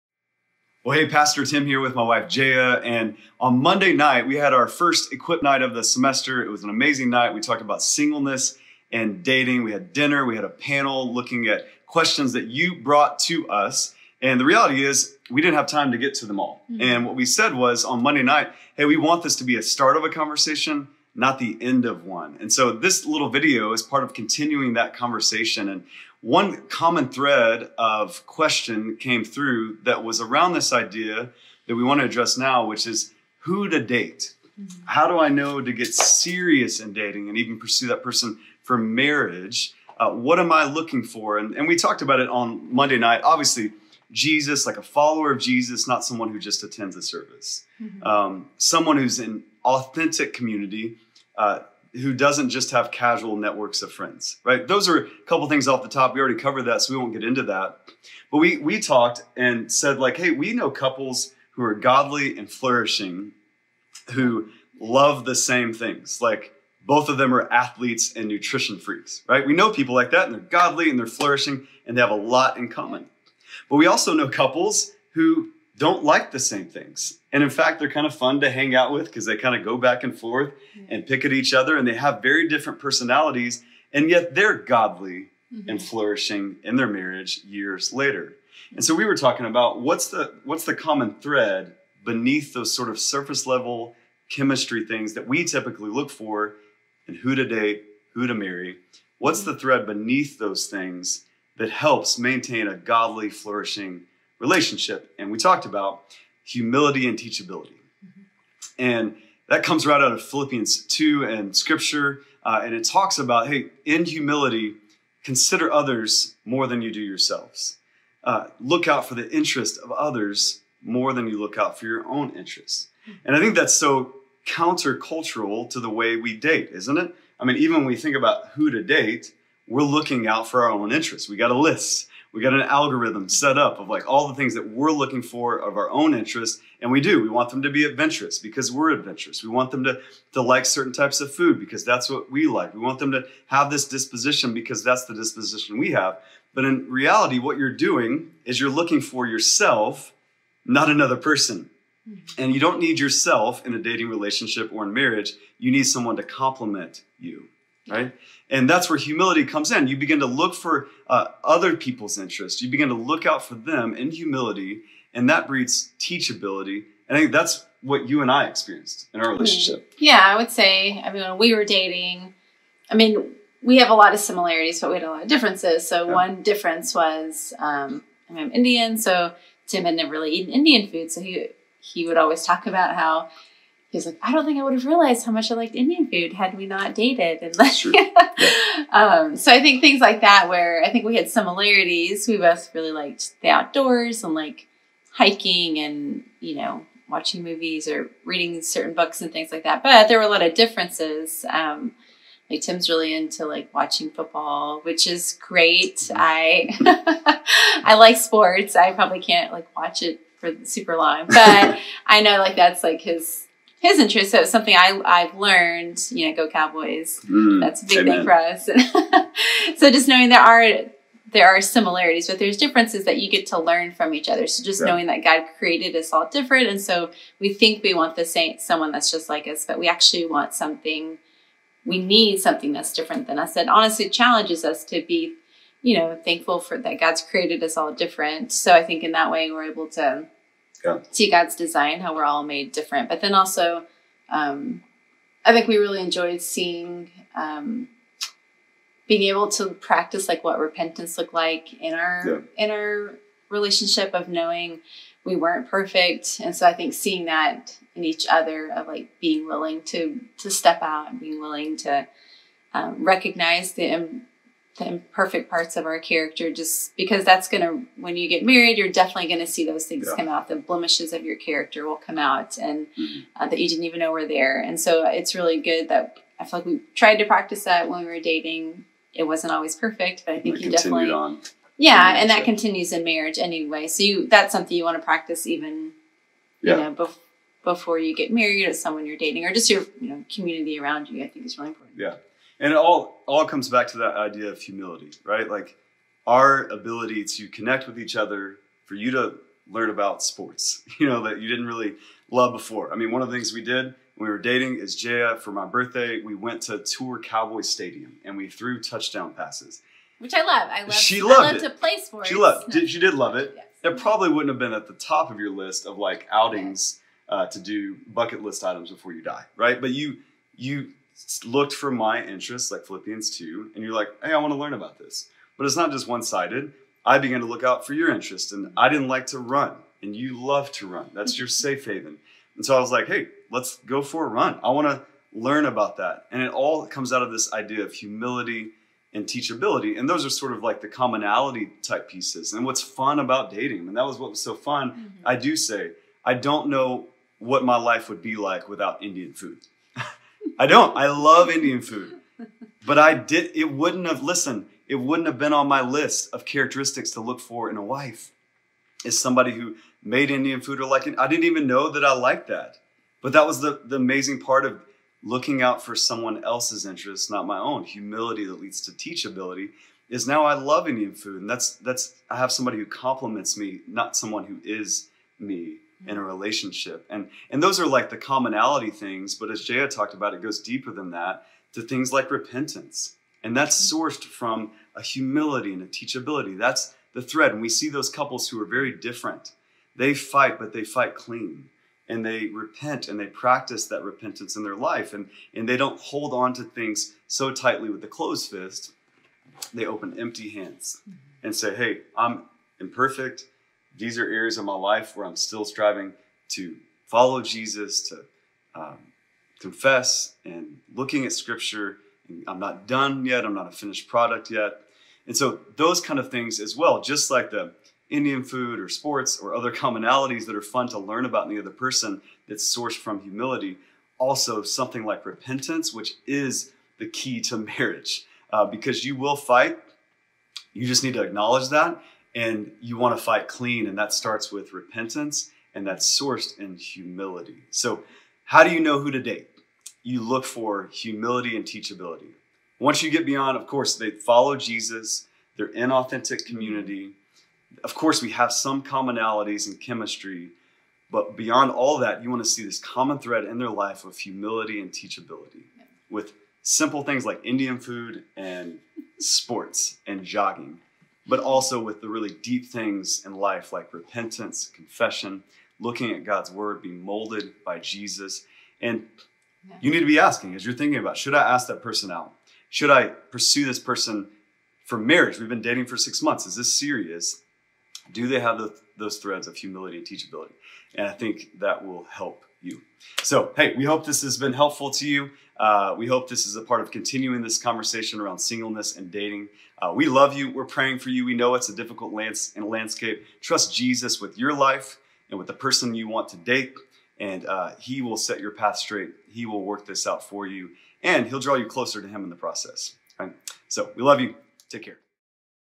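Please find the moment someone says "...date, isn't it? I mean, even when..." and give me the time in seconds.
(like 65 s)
126 s.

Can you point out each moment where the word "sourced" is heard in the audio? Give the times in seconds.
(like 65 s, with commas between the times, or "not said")
384 s, 422 s, 436 s.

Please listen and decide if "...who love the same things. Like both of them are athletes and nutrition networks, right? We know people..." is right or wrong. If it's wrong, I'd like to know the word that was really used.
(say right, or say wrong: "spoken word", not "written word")
wrong: "freaks", not "networks".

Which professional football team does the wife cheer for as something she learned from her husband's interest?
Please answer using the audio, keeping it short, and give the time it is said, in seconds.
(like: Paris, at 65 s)
Cowboys, at 216 s.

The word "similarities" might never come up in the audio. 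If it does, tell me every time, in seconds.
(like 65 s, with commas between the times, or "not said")
174 s, 191 s, 221 s.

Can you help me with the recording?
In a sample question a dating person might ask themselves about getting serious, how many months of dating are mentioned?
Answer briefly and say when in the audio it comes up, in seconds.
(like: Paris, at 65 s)
6, at 475 s.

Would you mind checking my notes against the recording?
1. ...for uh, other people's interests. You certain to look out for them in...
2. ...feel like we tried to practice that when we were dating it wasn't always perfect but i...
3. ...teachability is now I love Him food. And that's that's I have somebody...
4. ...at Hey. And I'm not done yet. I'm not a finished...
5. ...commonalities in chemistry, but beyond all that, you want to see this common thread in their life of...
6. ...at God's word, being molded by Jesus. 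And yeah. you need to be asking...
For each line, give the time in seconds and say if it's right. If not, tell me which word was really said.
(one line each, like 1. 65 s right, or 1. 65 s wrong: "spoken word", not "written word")
1. 160 s wrong: "begin", not "certain"
2. 276 s right
3. 368 s wrong: "Indian", not "Him"
4. 411 s wrong: "Scripture", not "Hey"
5. 448 s right
6. 466 s right.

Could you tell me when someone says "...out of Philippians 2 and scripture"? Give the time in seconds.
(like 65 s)
110 s.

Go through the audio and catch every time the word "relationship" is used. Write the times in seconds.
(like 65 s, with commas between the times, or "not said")
104 s, 154 s, 169 s, 253 s, 376 s.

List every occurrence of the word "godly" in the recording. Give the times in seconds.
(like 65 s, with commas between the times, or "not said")
61 s, 70 s, 84 s, 102 s.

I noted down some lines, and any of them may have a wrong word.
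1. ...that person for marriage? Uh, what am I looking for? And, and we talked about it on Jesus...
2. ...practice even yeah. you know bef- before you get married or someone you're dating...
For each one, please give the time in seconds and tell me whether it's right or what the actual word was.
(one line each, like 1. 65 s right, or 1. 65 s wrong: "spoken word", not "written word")
1. 37 s wrong: "Monday", not "Jesus"
2. 285 s right.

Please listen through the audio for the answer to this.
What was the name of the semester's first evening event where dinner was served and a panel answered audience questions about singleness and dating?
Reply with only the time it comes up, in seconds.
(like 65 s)
5 s.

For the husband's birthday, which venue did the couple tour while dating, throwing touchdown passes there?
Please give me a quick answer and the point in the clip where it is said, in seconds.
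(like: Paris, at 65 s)
Cowboy Stadium, at 307 s.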